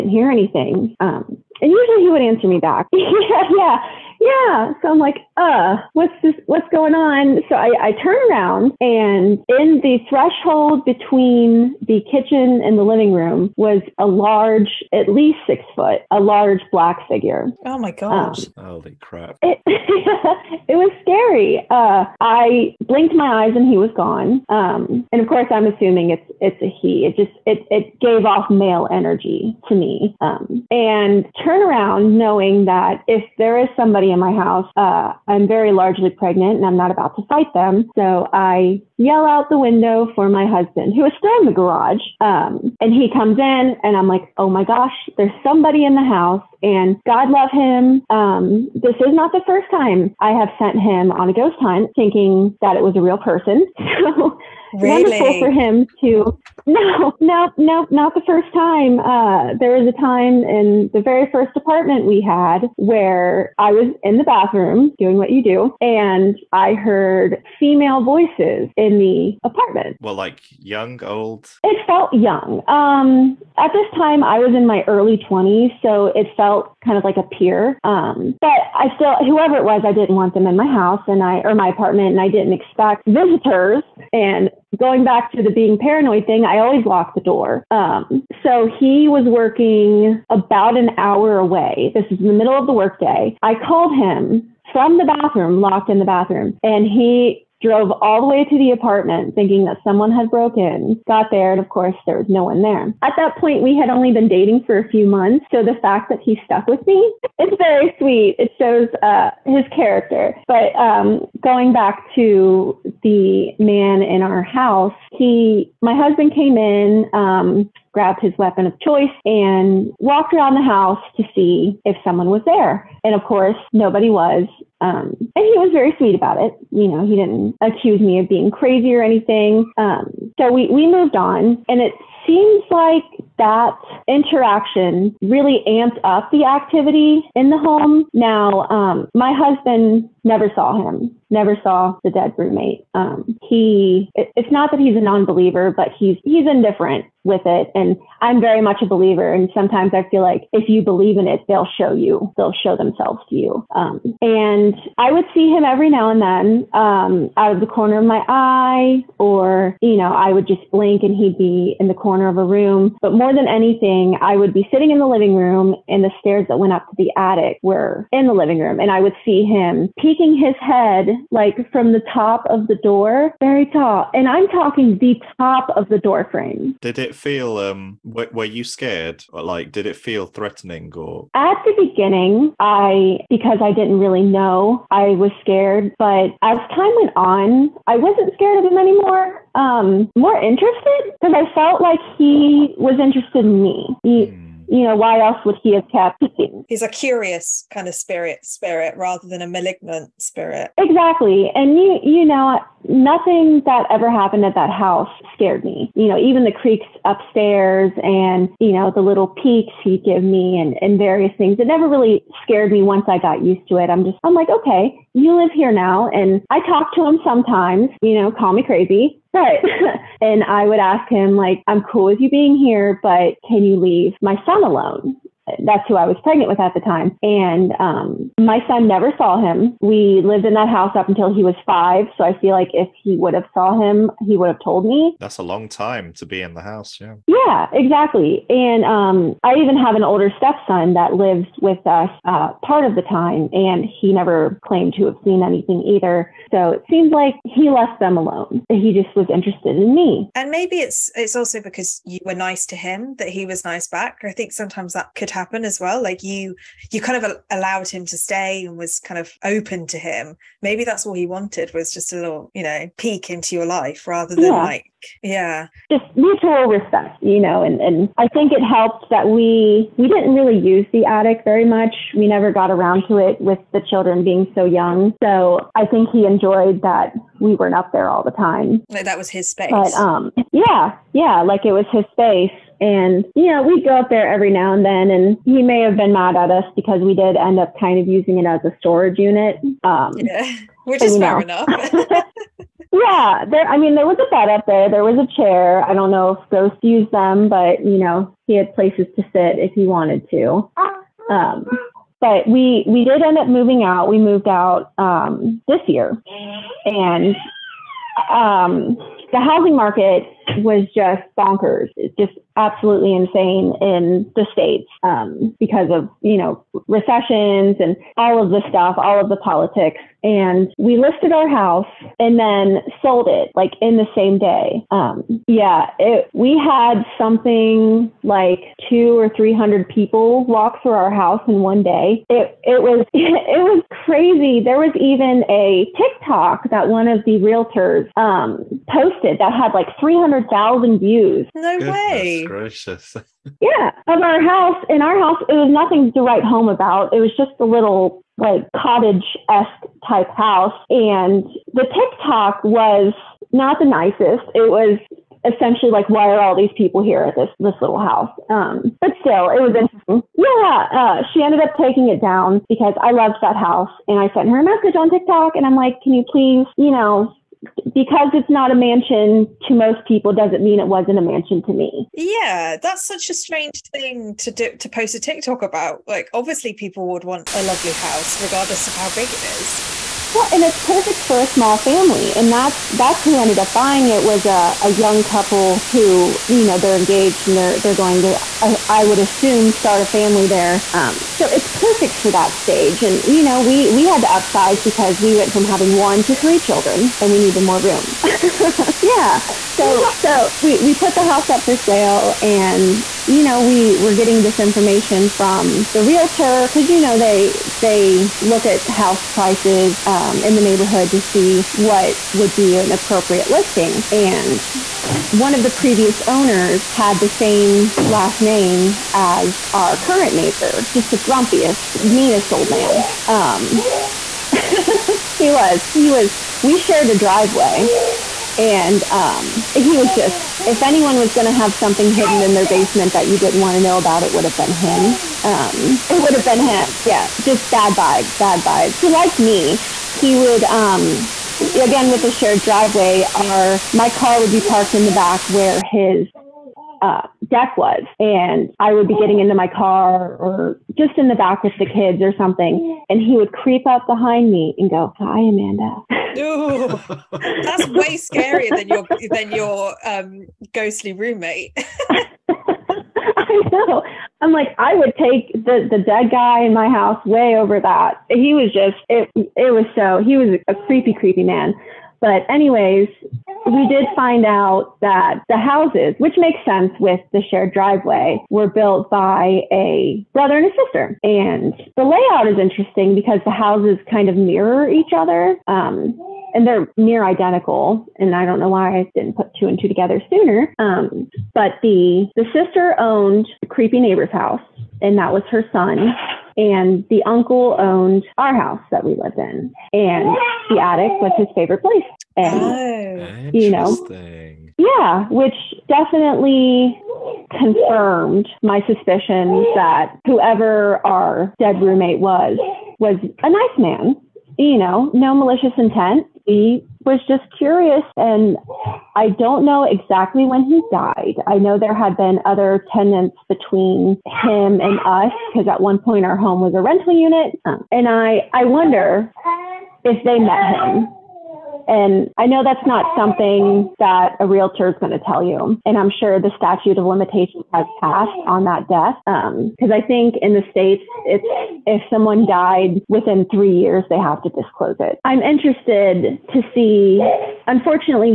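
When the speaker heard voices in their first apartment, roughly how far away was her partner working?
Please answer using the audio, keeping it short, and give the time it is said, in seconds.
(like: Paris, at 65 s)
An hour away, at 90 s.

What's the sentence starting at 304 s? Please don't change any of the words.
We moved out um, this year, and um, the housing market was just bonkers.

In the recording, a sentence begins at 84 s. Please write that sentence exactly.
And going back to the being paranoid thing, I always locked the door.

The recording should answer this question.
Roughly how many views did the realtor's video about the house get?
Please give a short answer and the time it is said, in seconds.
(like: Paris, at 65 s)
300,000, at 340 s.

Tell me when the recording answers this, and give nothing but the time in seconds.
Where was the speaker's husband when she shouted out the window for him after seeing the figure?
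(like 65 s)
41 s.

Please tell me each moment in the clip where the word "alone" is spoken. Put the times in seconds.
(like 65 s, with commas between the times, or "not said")
224 s, 248 s.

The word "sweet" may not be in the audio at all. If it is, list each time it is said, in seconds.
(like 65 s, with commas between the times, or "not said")
107 s, 125 s.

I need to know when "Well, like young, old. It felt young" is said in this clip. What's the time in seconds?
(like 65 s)
70 s.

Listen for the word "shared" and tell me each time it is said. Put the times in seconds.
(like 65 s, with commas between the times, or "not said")
426 s, 442 s, 477 s.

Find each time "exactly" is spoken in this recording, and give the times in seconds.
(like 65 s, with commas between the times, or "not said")
200 s, 237 s, 519 s.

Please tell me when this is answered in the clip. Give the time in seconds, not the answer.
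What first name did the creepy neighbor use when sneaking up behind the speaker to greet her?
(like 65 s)
455 s.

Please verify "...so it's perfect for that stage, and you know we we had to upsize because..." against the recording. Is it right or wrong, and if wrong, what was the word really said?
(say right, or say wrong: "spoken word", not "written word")
right.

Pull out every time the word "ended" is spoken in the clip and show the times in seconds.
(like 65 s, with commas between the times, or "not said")
361 s, 383 s.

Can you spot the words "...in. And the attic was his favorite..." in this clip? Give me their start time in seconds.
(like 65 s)
499 s.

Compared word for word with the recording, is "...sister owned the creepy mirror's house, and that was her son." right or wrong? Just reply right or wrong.
wrong.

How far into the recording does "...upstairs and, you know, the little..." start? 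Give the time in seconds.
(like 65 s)
207 s.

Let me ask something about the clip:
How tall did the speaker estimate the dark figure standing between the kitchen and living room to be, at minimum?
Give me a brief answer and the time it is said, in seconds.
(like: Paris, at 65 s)
6 foot, at 15 s.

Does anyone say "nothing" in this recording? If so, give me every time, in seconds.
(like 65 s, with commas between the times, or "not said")
202 s, 345 s.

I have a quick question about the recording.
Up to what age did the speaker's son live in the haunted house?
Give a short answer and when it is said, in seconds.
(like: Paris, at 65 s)
5, at 231 s.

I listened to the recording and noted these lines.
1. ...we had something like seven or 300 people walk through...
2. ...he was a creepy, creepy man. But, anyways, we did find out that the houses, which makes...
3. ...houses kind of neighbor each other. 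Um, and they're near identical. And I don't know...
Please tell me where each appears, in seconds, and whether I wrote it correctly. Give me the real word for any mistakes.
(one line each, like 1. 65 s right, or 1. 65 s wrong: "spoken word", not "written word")
1. 326 s wrong: "two", not "seven"
2. 470 s right
3. 483 s wrong: "mirror", not "neighbor".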